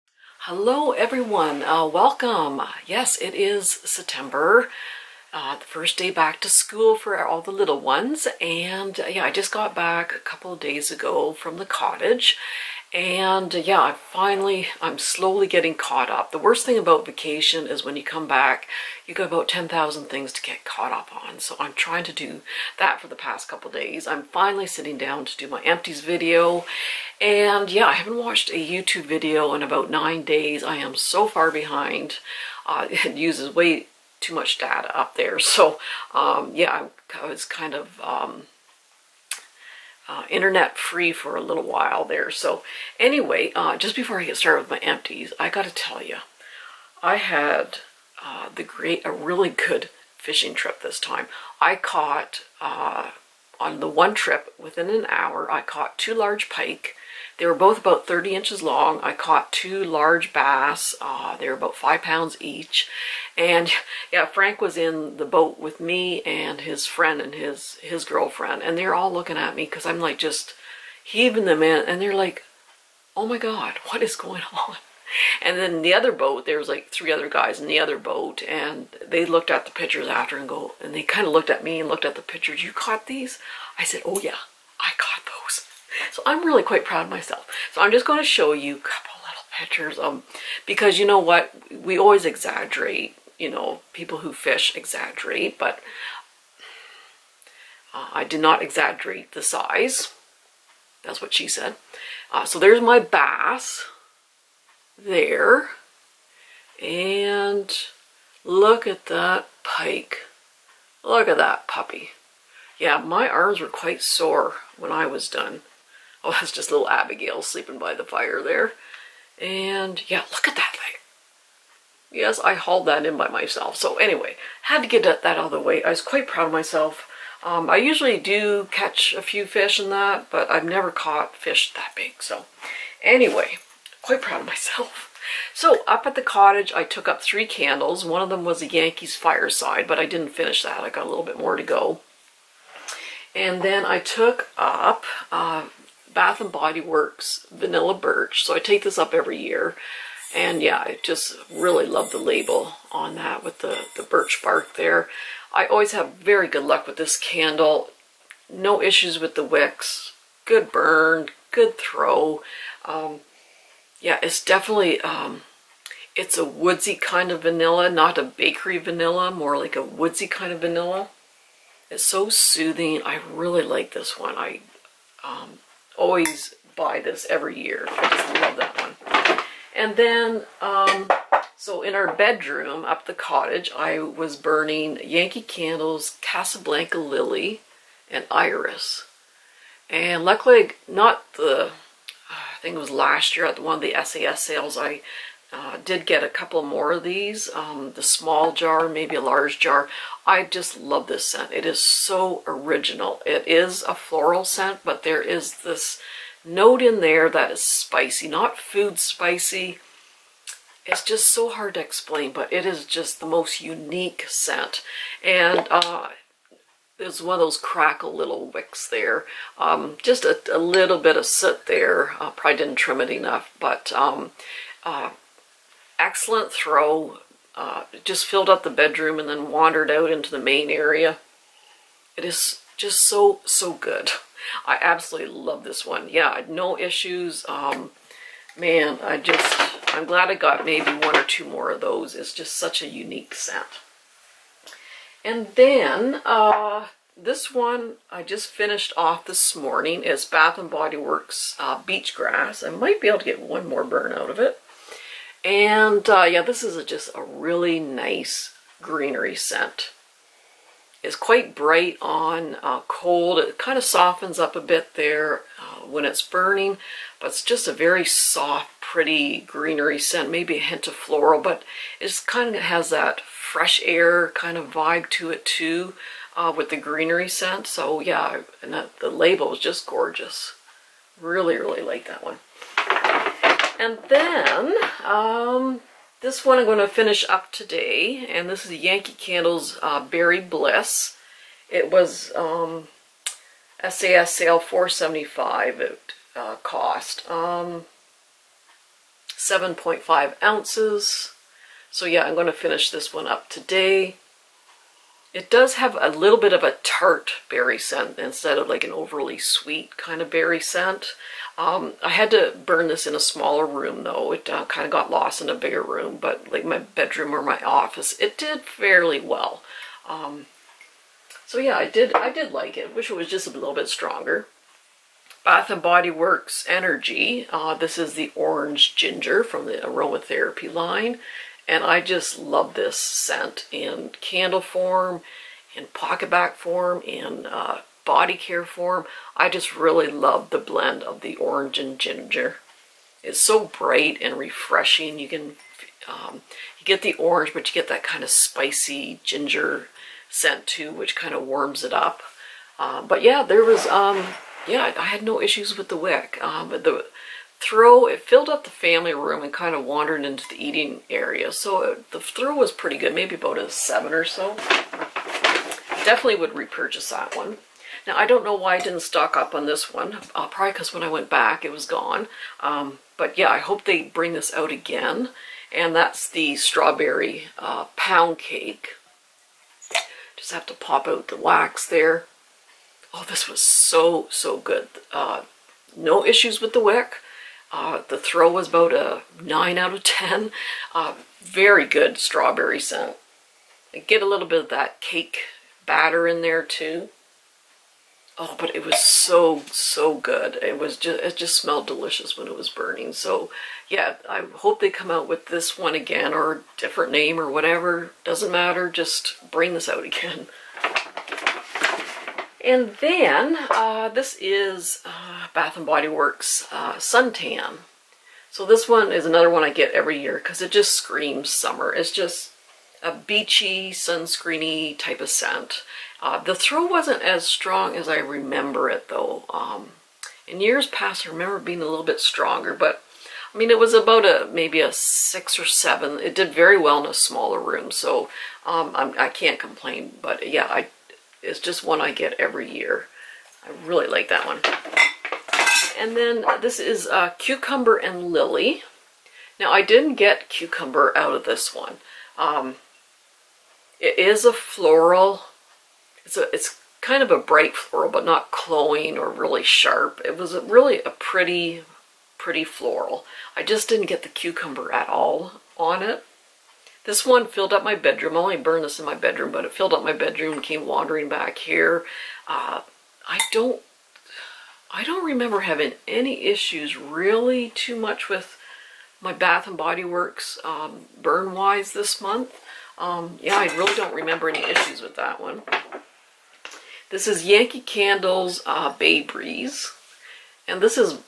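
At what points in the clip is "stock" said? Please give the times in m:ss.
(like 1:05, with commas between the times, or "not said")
6:09.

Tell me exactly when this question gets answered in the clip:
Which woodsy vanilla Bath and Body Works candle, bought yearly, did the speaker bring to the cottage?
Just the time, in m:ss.
2:27.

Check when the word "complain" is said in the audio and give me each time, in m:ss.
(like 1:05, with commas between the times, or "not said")
7:19.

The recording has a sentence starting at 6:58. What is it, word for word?
So this one is another one I get every year because it just screams summer.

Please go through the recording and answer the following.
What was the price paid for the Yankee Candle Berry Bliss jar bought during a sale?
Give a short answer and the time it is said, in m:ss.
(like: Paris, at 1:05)
4.75, at 4:54.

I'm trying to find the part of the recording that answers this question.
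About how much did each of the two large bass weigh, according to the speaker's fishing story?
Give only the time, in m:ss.
1:01.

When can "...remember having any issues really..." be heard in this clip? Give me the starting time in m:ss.
7:55.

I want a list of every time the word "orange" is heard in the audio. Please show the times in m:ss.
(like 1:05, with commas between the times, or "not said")
5:28, 5:41, 5:47.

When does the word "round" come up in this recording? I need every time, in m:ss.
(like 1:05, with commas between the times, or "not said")
not said.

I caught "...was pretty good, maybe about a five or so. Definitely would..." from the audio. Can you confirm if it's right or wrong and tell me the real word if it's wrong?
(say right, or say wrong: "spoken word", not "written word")
wrong: "seven", not "five".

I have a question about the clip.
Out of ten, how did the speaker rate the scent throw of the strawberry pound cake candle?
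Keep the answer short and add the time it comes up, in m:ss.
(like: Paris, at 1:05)
9, at 6:29.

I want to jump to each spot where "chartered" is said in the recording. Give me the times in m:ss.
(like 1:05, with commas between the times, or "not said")
not said.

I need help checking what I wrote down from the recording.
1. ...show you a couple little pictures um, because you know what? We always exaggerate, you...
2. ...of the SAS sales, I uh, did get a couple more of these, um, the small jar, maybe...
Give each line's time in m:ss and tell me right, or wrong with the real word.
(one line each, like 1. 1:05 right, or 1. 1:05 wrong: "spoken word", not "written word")
1. 1:28 right
2. 3:13 right.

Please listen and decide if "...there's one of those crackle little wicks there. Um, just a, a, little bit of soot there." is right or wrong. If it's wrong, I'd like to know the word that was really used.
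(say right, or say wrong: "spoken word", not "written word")
right.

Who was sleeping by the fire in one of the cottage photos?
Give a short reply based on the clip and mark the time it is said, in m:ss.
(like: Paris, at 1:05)
Abigail, at 1:56.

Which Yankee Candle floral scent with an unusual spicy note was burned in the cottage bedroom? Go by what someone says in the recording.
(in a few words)
Casablanca Lily and Iris.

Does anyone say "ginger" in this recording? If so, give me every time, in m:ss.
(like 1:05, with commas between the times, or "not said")
5:28, 5:41, 5:49.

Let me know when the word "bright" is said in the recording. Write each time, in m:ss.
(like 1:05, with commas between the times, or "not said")
4:21, 5:43, 7:37.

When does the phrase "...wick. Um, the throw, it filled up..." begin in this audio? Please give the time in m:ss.
5:55.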